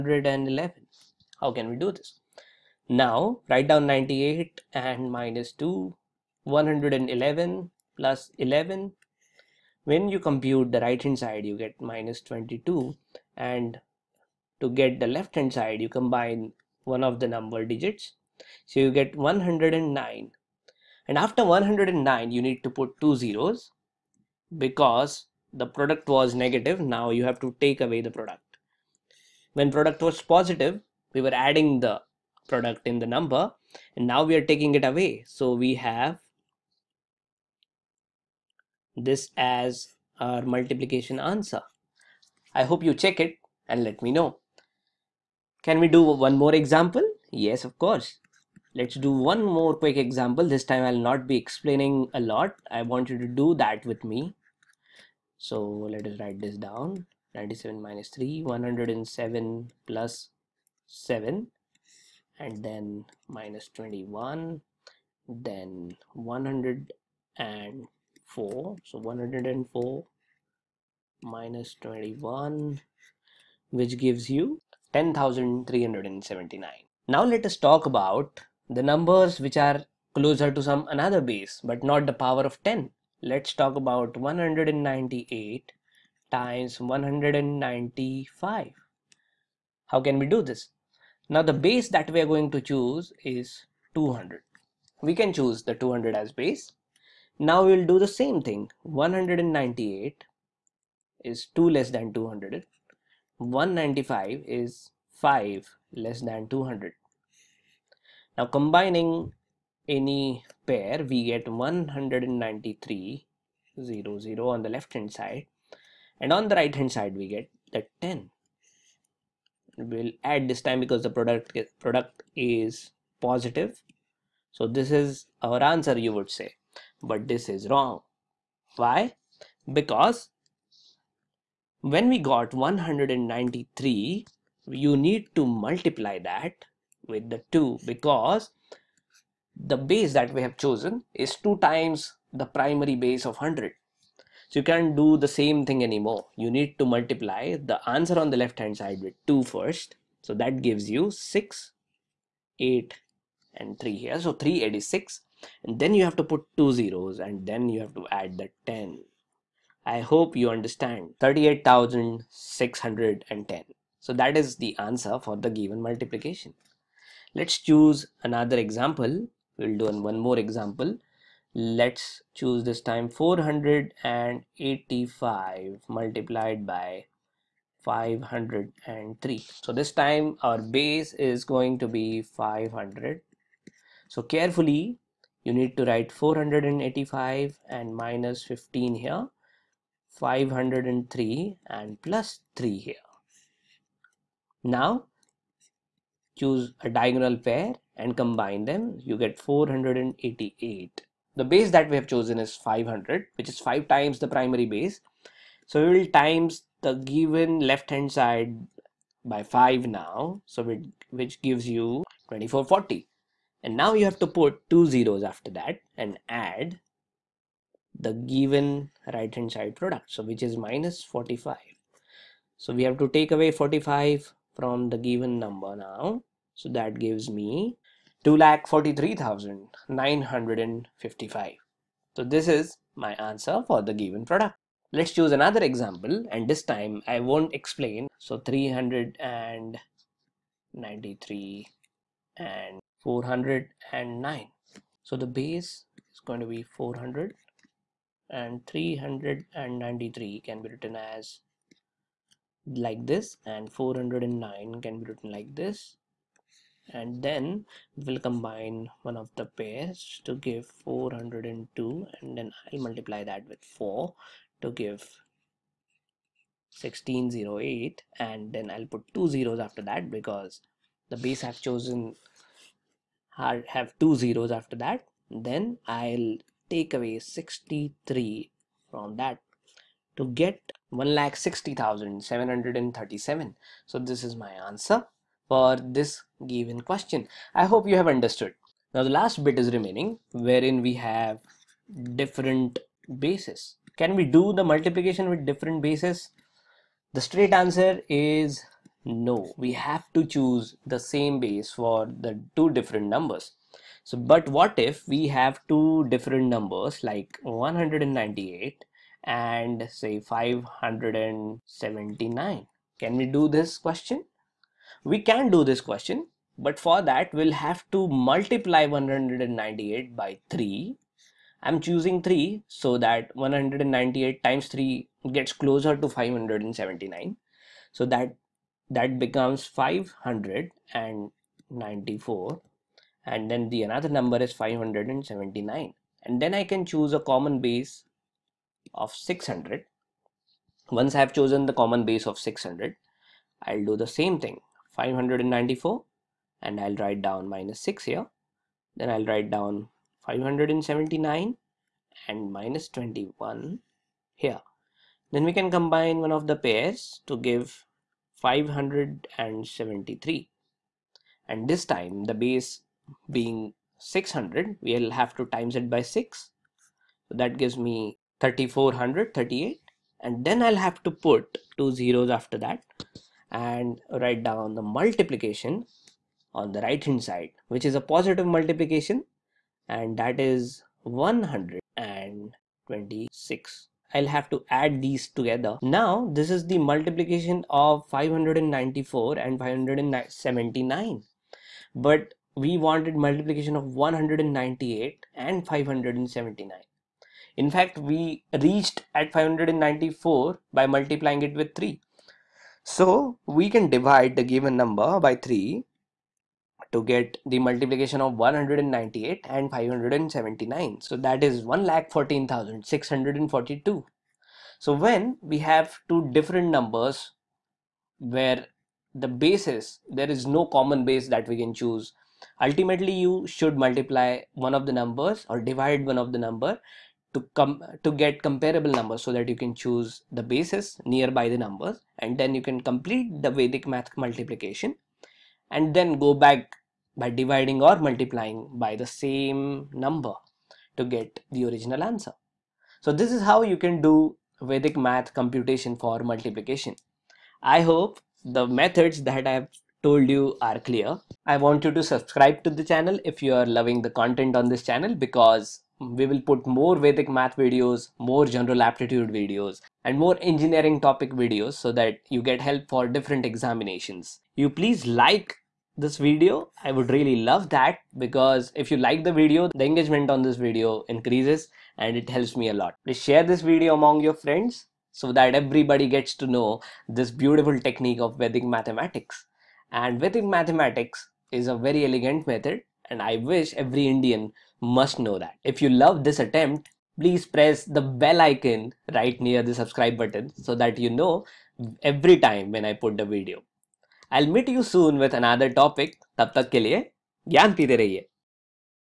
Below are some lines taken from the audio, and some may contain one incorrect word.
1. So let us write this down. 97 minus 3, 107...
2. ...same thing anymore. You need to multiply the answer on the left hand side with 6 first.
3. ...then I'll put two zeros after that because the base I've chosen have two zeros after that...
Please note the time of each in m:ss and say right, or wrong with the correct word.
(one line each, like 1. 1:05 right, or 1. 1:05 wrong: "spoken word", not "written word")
1. 0:55 right
2. 2:25 wrong: "2", not "6"
3. 4:28 right.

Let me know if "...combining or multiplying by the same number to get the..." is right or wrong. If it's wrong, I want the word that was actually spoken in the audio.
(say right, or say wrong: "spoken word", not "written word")
wrong: "dividing", not "combining".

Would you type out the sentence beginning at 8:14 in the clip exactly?
I'll meet you soon with another topic.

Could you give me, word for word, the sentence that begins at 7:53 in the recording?
Please share this video among your friends so that everybody gets to know this beautiful technique of Vedic mathematics.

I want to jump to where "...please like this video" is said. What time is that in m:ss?
7:44.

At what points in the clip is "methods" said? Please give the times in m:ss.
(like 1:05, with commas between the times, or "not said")
7:28, 8:02.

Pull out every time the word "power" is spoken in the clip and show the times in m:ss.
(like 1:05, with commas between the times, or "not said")
1:22.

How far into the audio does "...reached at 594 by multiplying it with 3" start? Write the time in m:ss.
6:38.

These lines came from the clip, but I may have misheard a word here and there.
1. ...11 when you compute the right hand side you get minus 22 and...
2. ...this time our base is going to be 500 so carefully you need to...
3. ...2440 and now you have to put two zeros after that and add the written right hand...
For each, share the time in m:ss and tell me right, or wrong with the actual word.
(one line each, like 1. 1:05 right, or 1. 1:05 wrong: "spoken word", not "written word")
1. 0:08 right
2. 2:59 right
3. 3:32 wrong: "given", not "written".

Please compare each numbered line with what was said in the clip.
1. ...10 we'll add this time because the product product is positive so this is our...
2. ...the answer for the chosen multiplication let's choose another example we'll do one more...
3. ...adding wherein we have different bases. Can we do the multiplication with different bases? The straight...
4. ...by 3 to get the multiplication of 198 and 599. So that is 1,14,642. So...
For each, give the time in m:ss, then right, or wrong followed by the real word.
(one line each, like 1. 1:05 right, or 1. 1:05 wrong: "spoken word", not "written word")
1. 1:58 right
2. 2:44 wrong: "given", not "chosen"
3. 4:49 wrong: "remaining", not "adding"
4. 6:45 wrong: "579", not "599".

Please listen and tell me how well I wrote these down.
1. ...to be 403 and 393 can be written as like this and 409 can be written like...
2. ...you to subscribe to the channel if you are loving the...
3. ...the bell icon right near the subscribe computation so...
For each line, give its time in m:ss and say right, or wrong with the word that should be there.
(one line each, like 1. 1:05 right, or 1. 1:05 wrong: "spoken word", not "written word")
1. 4:06 wrong: "400", not "403"
2. 7:31 right
3. 8:07 wrong: "button", not "computation".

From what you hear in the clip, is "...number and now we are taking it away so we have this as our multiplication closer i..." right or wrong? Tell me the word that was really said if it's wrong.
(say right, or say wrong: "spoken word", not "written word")
wrong: "answer", not "closer".